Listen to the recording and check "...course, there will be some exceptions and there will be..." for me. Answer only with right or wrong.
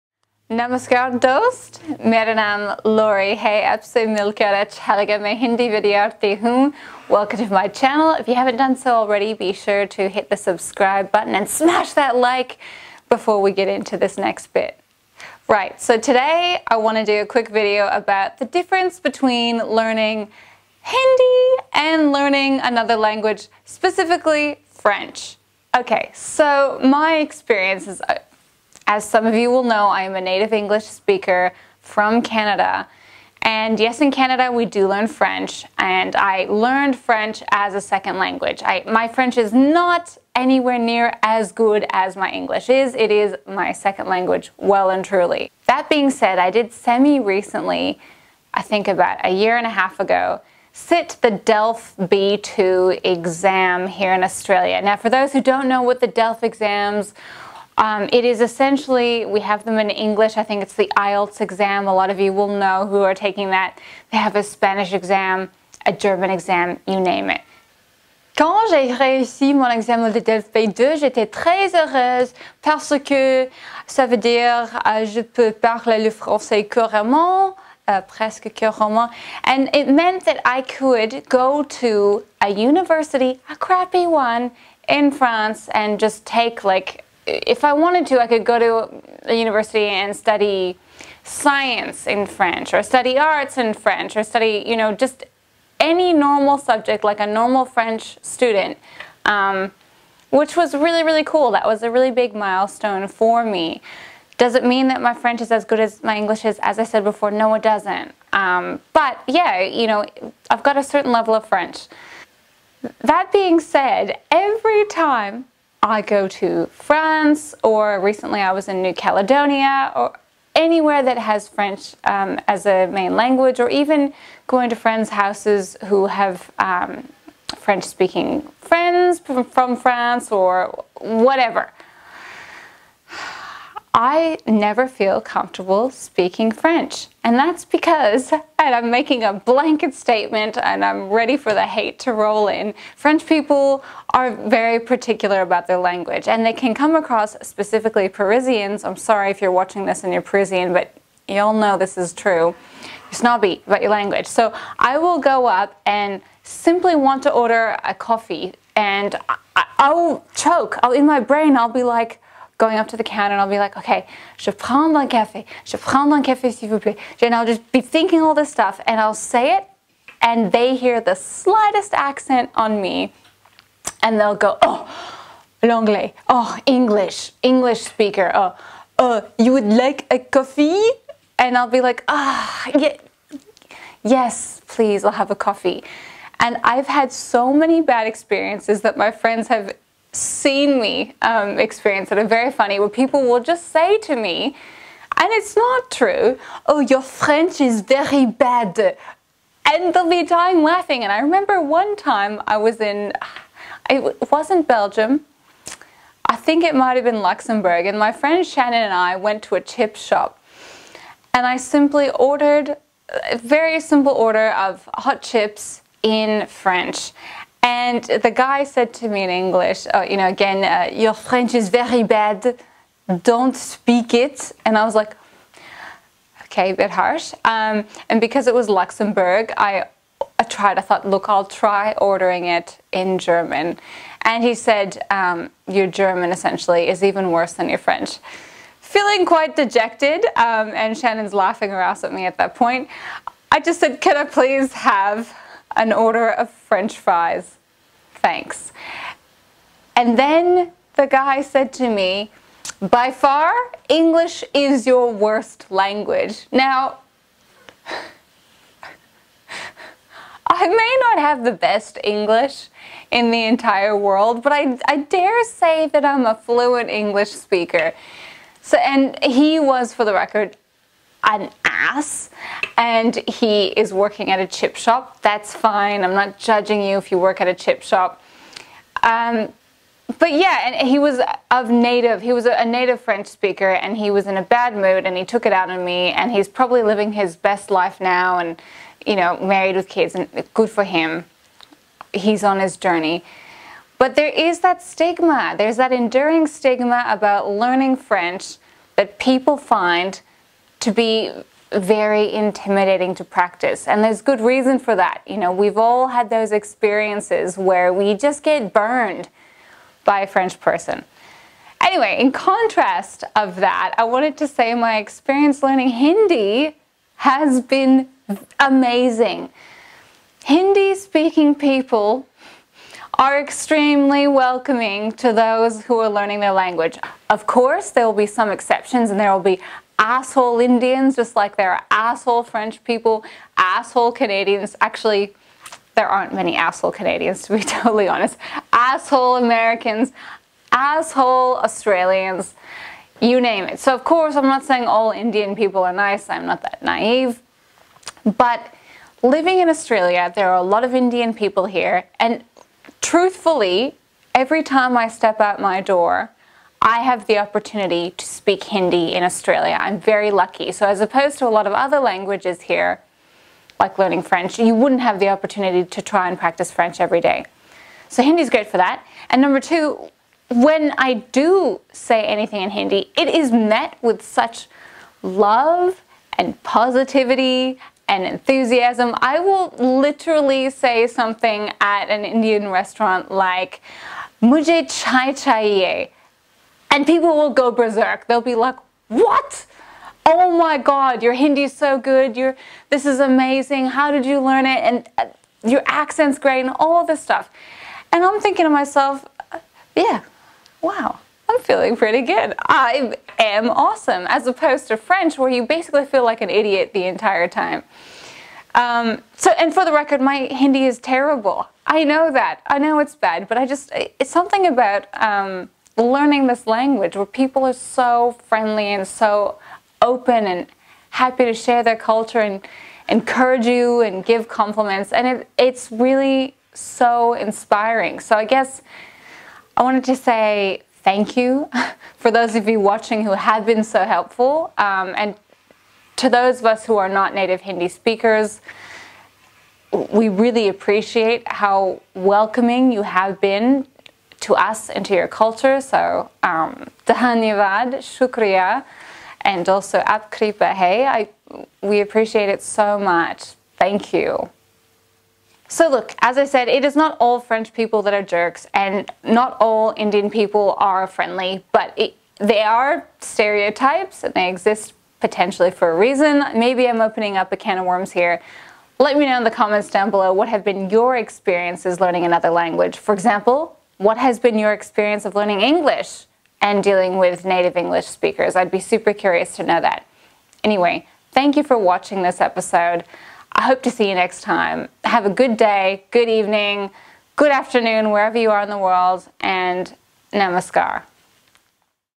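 right.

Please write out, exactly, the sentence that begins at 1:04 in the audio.
They have a Spanish exam, a German exam, you name it.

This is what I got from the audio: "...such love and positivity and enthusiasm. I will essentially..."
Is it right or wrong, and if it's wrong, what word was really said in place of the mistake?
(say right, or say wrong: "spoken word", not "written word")
wrong: "literally", not "essentially".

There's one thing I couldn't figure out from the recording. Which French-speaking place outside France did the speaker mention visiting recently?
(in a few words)
New Caledonia.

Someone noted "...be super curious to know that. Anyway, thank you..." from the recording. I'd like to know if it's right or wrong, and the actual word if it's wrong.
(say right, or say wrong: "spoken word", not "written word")
right.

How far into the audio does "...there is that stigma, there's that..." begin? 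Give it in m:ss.
4:54.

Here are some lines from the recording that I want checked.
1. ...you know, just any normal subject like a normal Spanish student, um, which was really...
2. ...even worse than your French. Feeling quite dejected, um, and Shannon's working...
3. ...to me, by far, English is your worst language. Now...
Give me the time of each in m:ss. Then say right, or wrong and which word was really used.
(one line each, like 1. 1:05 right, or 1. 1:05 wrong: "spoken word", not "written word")
1. 1:34 wrong: "French", not "Spanish"
2. 3:57 wrong: "laughing", not "working"
3. 4:11 right.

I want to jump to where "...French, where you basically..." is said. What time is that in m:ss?
6:44.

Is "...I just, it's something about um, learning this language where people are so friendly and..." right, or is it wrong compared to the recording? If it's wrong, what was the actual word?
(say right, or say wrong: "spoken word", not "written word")
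right.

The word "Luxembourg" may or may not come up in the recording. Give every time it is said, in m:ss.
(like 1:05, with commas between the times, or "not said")
3:27, 3:48.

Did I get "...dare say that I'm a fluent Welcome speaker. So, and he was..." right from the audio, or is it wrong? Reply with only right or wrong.
wrong.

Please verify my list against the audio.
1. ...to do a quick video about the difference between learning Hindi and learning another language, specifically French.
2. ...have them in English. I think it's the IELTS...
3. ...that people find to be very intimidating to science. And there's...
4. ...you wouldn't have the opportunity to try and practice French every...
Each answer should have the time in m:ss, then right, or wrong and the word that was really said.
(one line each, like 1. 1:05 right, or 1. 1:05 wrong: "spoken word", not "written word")
1. 0:16 right
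2. 0:59 right
3. 4:58 wrong: "practice", not "science"
4. 6:04 right.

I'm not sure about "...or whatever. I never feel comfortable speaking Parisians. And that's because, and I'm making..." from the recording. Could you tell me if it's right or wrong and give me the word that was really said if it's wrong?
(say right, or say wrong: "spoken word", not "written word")
wrong: "French", not "Parisians".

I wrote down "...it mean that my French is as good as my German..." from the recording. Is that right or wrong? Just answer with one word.
wrong.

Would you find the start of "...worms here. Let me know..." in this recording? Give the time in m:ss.
7:47.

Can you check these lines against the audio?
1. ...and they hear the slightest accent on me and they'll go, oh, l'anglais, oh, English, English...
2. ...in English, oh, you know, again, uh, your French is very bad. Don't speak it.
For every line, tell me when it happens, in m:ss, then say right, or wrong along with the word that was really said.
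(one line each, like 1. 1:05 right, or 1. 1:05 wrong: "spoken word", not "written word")
1. 2:50 right
2. 3:39 right.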